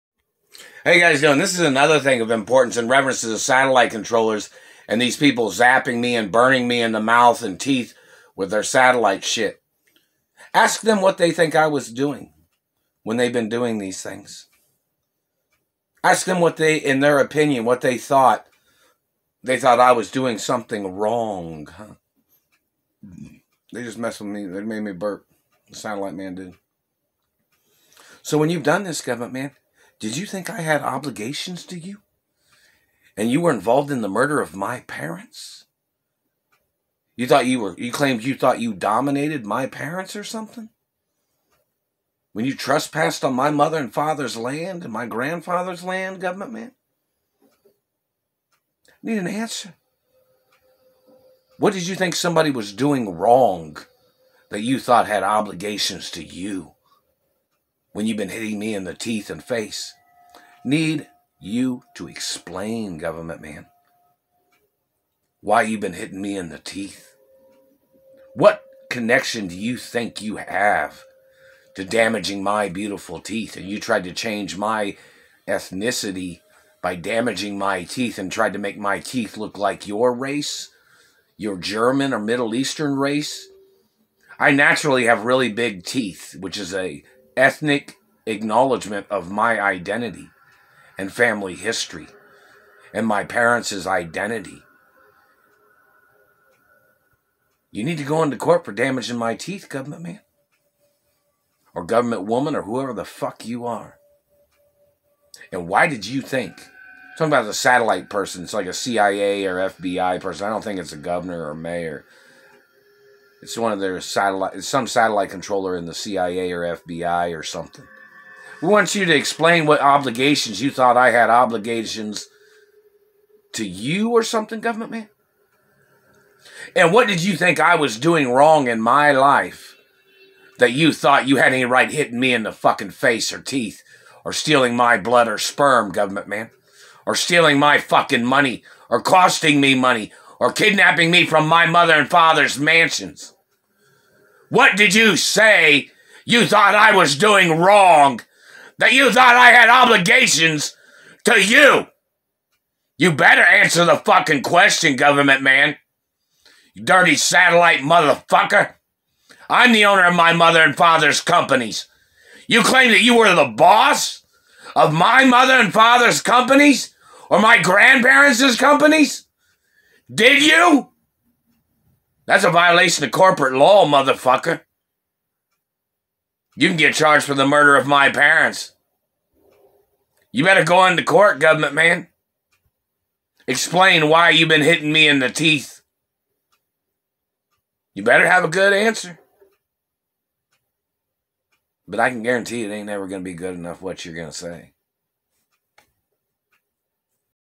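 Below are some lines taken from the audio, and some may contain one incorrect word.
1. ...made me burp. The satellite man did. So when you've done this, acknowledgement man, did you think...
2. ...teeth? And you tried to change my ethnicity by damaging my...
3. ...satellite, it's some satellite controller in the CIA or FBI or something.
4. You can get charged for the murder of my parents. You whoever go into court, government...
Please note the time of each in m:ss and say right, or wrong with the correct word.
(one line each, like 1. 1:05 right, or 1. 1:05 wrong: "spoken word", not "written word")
1. 0:24 wrong: "government", not "acknowledgement"
2. 1:13 right
3. 1:54 right
4. 2:56 wrong: "better", not "whoever".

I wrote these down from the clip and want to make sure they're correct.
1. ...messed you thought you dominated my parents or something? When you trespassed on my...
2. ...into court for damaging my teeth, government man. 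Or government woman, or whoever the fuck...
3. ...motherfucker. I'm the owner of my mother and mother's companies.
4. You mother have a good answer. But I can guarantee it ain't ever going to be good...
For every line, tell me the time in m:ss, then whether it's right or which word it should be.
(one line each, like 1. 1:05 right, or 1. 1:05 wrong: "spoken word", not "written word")
1. 0:37 wrong: "claimed", not "messed"
2. 1:38 right
3. 2:37 wrong: "father", not "mother"
4. 3:07 wrong: "better", not "mother".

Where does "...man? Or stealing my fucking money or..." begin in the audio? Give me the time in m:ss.
2:16.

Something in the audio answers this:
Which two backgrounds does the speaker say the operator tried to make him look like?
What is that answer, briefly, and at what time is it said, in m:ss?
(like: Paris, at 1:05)
German or Middle Eastern, at 1:21.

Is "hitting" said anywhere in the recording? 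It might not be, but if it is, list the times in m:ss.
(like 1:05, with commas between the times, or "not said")
0:58, 1:05, 2:11, 3:04.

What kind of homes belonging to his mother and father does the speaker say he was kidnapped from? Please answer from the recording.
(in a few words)
mansions.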